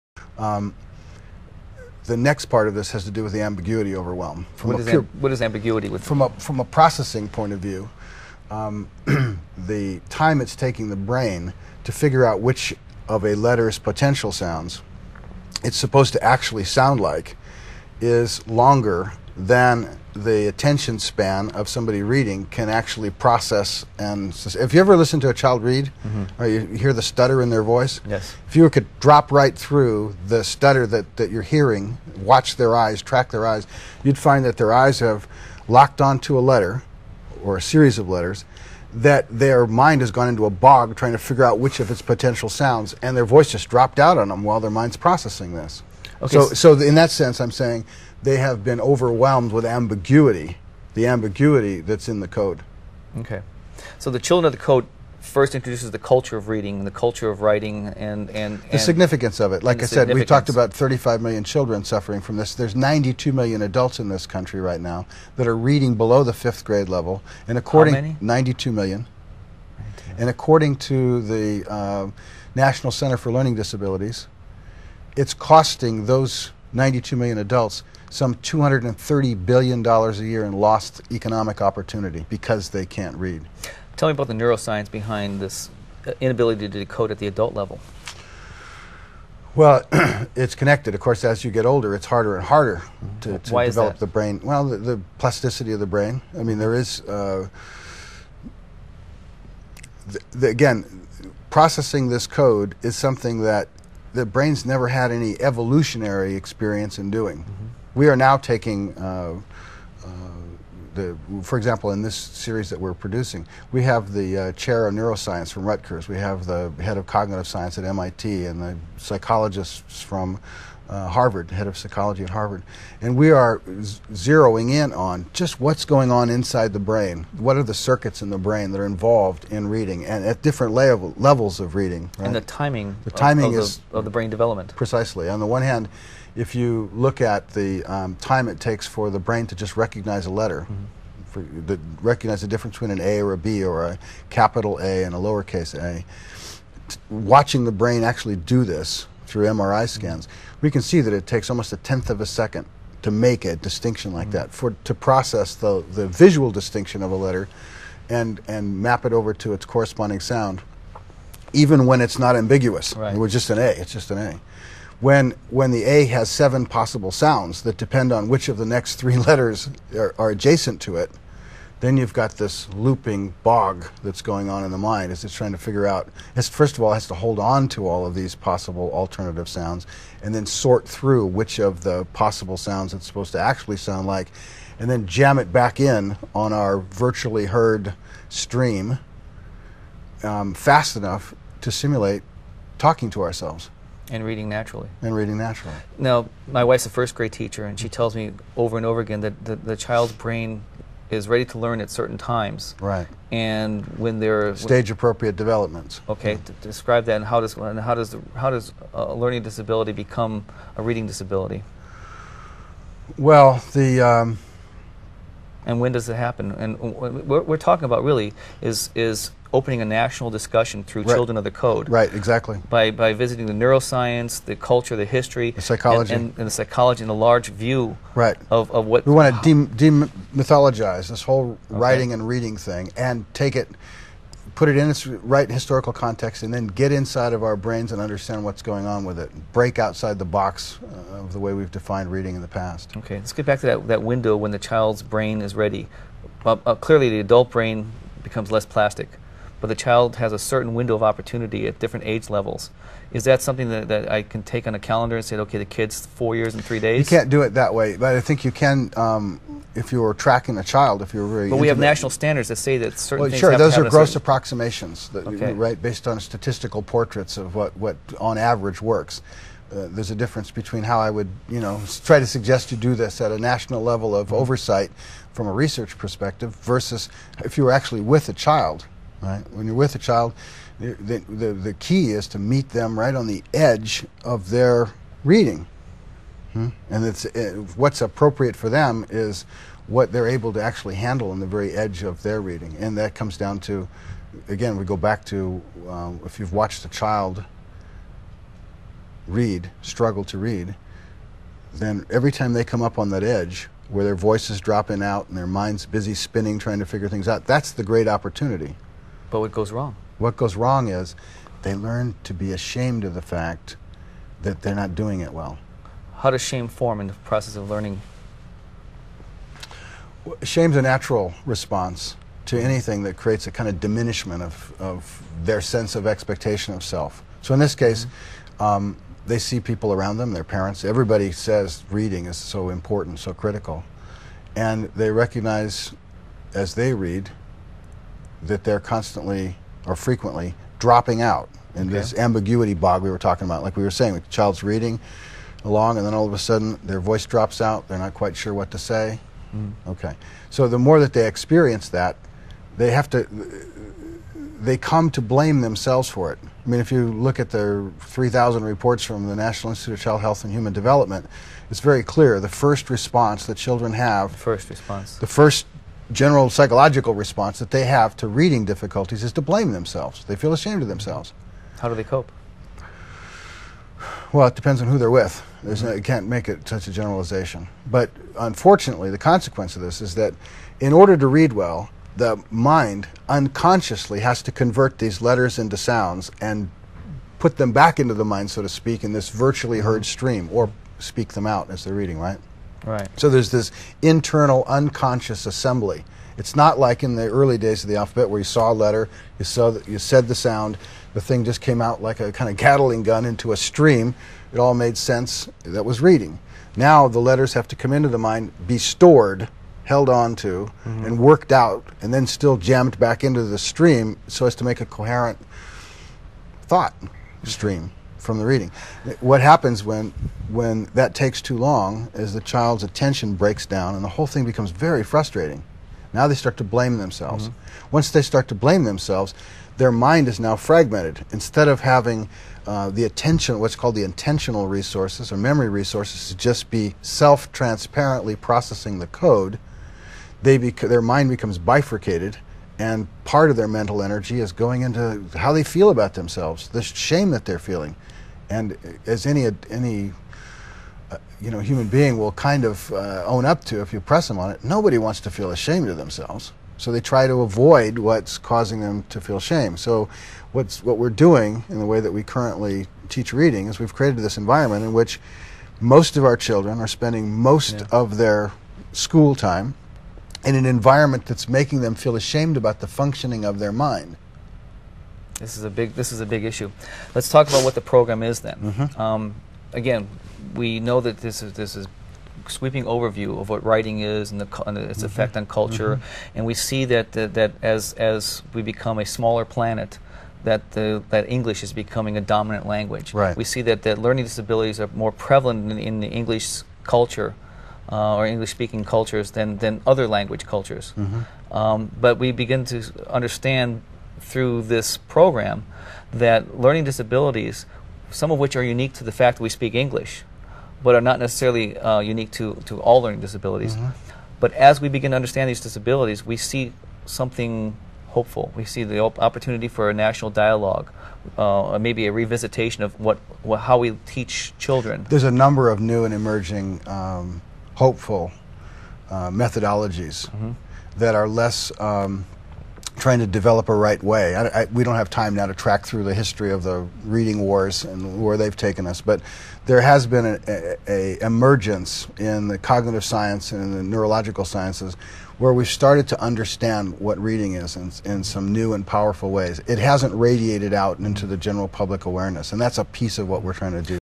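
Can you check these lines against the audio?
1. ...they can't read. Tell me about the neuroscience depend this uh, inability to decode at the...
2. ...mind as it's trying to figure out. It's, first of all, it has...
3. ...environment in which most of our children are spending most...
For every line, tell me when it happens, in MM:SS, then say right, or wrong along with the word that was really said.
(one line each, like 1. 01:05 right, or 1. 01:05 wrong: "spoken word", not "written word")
1. 01:22 wrong: "behind", not "depend"
2. 02:54 right
3. 07:44 right.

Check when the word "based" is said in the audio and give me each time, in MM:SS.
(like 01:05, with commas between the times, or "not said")
04:25.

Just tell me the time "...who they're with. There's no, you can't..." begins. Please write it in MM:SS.
06:14.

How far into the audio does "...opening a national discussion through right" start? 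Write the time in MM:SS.
03:39.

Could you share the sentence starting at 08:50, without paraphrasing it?
that are less um, trying to develop a right way.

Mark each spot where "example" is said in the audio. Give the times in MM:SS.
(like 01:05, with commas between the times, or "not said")
01:51.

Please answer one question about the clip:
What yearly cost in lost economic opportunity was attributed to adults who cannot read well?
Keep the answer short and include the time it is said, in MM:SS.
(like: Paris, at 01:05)
$230 billion, at 01:18.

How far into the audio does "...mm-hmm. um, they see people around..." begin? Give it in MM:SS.
05:28.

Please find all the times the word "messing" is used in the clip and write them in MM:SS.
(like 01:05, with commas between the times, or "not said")
not said.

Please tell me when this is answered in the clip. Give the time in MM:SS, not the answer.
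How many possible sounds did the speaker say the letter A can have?
02:46.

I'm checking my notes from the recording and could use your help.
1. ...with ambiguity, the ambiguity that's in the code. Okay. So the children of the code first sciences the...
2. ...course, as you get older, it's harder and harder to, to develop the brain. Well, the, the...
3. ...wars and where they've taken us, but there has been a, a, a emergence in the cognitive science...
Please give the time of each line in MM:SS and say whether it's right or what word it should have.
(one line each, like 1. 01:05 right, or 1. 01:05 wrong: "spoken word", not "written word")
1. 00:49 wrong: "introduces", not "sciences"
2. 01:31 right
3. 08:57 right.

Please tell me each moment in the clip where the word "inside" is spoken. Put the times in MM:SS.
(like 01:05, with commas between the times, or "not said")
02:06, 03:56.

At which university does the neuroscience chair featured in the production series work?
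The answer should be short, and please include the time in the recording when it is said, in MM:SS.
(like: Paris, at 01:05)
Rutgers, at 01:55.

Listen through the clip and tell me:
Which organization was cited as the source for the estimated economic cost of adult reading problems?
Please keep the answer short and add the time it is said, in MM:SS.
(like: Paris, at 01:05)
National Center for Learning Disabilities, at 01:12.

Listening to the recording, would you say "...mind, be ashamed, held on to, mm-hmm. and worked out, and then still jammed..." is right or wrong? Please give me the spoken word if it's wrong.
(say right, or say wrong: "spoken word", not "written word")
wrong: "stored", not "ashamed".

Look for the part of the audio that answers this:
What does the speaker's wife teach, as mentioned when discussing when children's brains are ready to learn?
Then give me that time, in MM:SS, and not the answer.
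03:16.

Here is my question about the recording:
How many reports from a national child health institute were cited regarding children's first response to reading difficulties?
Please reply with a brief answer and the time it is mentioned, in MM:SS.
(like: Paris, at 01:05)
3,000, at 05:57.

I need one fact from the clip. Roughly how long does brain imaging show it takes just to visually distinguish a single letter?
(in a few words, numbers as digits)
a tenth of a second.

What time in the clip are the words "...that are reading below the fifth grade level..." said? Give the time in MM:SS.
01:05.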